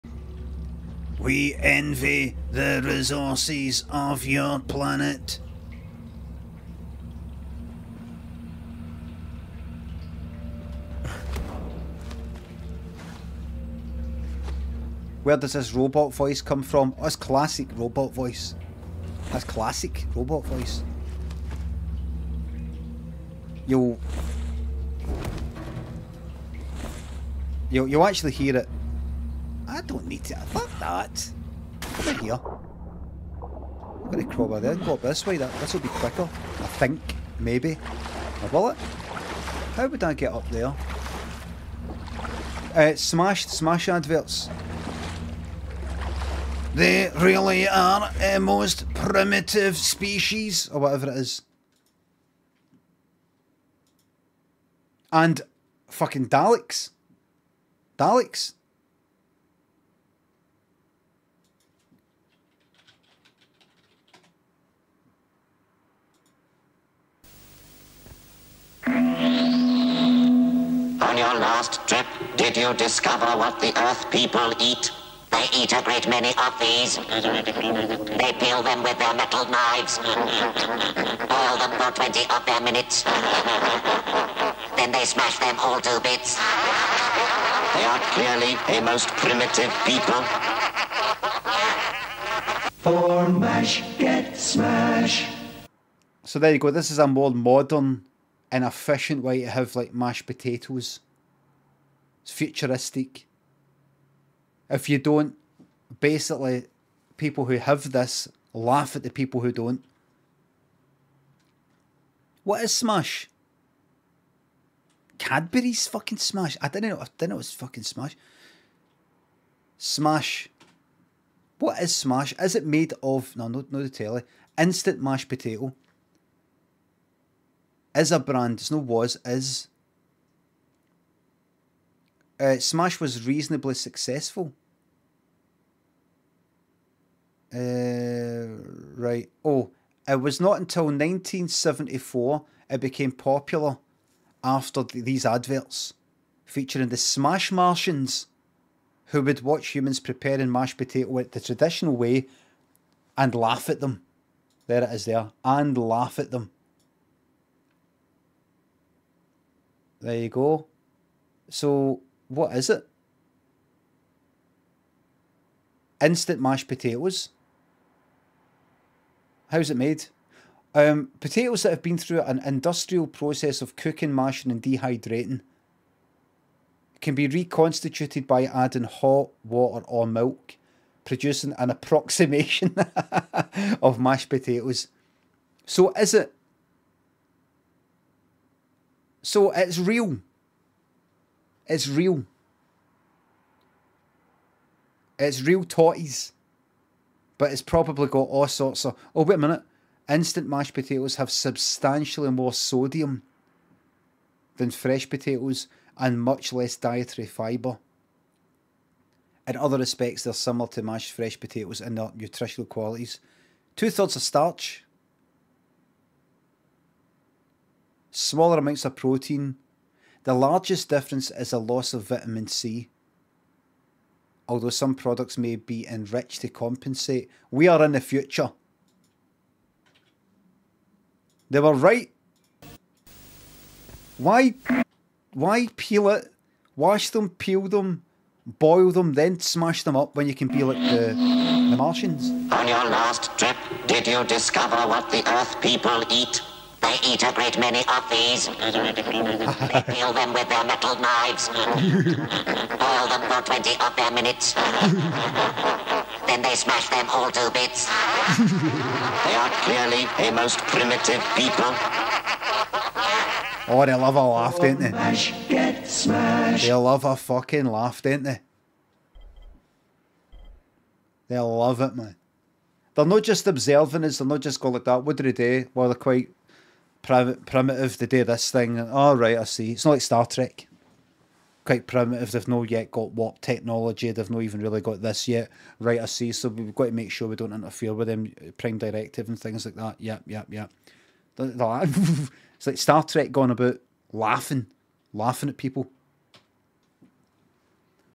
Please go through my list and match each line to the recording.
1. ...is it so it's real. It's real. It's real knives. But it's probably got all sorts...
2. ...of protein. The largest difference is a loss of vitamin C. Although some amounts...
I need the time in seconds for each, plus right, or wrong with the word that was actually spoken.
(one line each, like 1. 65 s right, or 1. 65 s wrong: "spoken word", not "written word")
1. 185 s wrong: "totties", not "knives"
2. 218 s wrong: "products", not "amounts".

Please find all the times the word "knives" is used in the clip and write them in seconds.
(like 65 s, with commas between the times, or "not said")
79 s, 250 s.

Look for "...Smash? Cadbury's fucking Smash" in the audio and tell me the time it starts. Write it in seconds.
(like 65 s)
112 s.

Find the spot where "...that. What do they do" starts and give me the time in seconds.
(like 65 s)
274 s.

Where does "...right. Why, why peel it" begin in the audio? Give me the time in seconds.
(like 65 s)
231 s.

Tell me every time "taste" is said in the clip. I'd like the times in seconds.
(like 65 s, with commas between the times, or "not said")
not said.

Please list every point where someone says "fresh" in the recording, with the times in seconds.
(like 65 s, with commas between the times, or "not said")
204 s, 211 s.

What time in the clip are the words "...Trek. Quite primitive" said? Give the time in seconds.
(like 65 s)
280 s.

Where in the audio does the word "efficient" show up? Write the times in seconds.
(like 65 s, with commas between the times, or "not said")
98 s.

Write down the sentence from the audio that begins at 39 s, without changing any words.
How would I get up there?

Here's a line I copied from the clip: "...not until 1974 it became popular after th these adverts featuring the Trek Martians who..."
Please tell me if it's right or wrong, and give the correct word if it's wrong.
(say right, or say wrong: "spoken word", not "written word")
wrong: "Smash", not "Trek".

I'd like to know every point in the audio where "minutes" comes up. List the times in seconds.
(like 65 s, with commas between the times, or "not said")
82 s, 199 s, 254 s.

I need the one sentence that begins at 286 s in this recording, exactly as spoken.
So we've got to make sure we don't interfere with them.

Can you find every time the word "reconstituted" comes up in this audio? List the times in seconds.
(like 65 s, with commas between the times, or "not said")
177 s.